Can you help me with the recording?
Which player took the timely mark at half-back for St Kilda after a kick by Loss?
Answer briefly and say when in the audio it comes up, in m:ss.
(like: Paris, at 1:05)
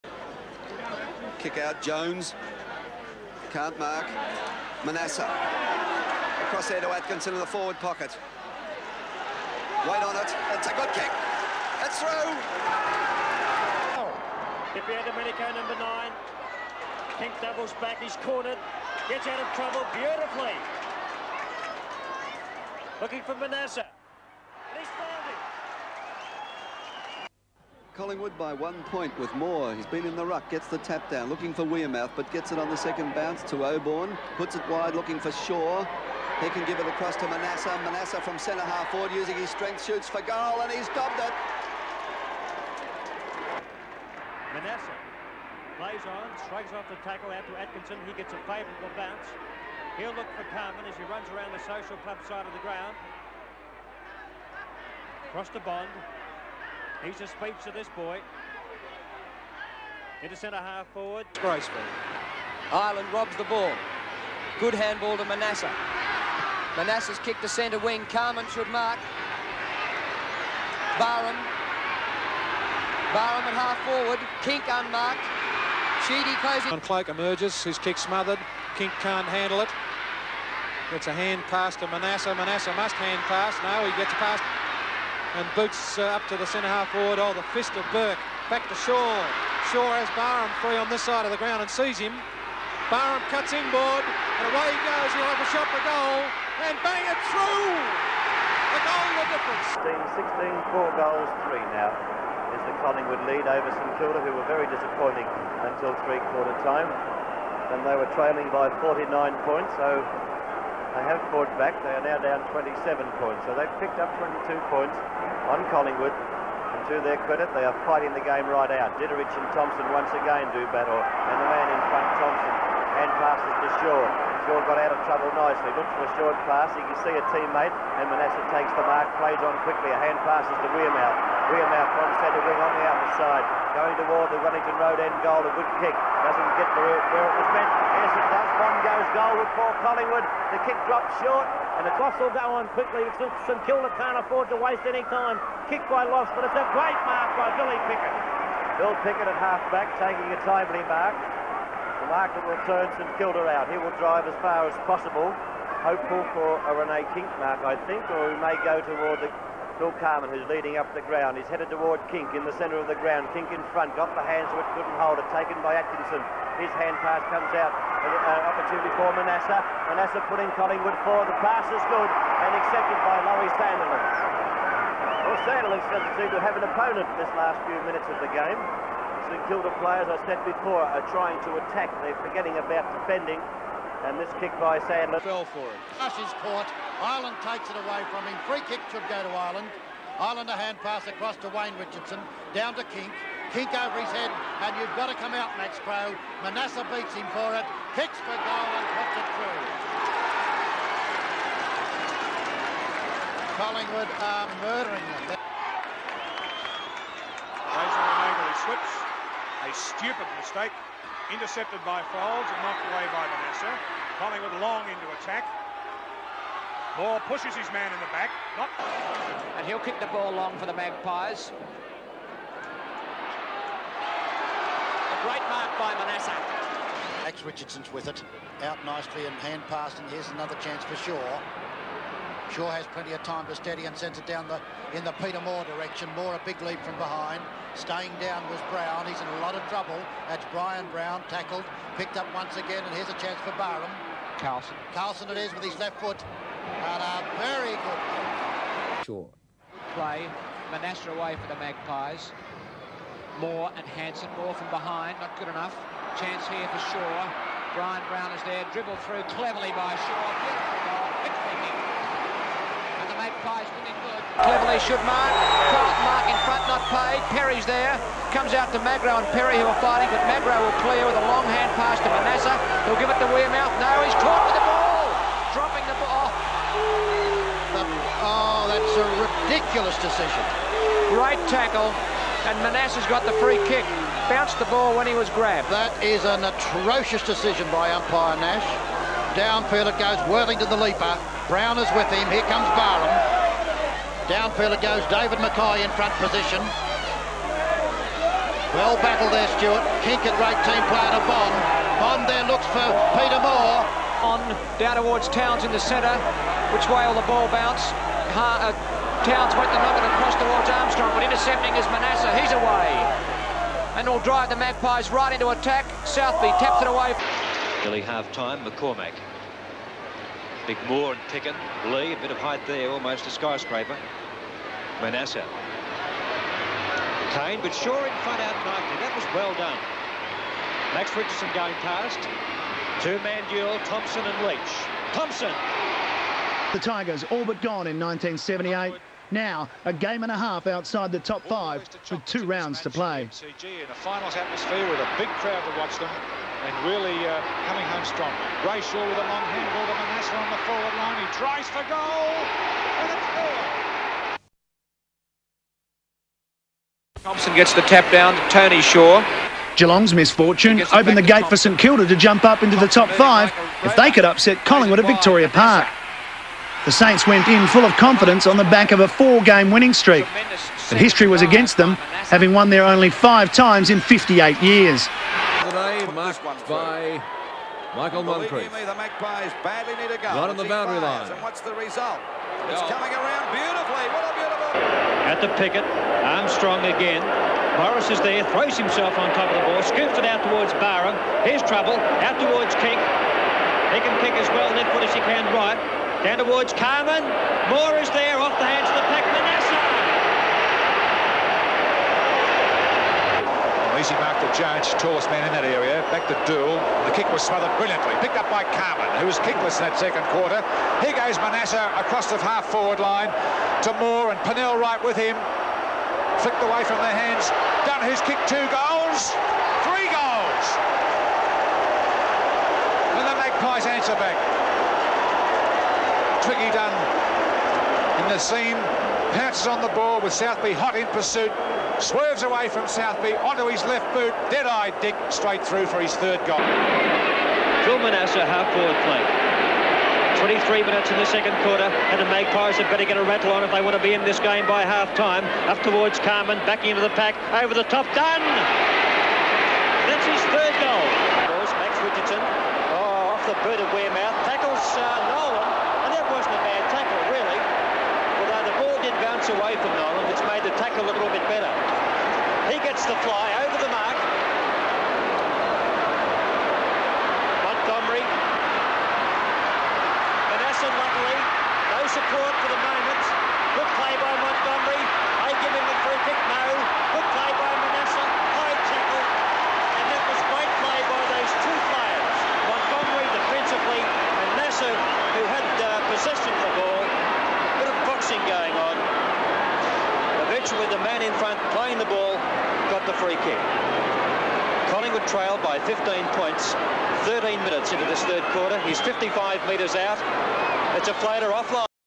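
Billy Picken, at 2:27.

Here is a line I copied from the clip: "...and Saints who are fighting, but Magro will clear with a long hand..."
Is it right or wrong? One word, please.
wrong.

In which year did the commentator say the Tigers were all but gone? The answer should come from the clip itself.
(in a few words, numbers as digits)
1978.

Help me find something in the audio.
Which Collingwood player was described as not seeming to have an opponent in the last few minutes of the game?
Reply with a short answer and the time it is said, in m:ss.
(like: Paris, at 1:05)
Laurie Sanderlin, at 2:53.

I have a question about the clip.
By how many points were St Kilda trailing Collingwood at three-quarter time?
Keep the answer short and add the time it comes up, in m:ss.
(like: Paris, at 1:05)
49, at 1:48.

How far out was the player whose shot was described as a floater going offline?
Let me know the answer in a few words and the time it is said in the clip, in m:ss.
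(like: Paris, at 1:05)
55 metres, at 8:18.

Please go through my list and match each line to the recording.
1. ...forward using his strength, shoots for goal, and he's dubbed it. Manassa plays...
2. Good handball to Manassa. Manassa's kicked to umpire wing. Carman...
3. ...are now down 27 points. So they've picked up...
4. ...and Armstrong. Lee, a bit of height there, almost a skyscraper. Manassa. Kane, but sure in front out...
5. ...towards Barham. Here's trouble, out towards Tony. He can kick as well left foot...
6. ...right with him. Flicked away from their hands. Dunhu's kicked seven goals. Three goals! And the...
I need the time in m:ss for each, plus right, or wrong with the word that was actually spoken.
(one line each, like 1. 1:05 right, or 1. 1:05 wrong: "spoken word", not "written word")
1. 0:38 right
2. 1:04 wrong: "centre", not "umpire"
3. 1:51 right
4. 5:21 wrong: "Picken", not "Armstrong"
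5. 6:30 wrong: "King", not "Tony"
6. 6:54 wrong: "two", not "seven".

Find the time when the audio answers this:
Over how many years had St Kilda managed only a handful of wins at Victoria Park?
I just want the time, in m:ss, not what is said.
6:13.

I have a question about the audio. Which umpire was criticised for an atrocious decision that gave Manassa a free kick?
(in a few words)
Nash.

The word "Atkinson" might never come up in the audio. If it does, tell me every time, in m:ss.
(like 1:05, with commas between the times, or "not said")
0:06, 0:47, 2:45.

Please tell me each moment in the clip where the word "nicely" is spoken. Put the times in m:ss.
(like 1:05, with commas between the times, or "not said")
2:05, 3:48, 5:28.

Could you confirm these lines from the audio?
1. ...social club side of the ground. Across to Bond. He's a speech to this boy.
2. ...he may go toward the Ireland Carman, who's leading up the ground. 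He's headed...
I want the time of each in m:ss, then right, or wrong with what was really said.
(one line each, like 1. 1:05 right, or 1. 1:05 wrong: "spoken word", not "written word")
1. 0:51 right
2. 2:38 wrong: "Phil", not "Ireland".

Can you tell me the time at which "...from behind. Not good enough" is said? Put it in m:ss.
4:14.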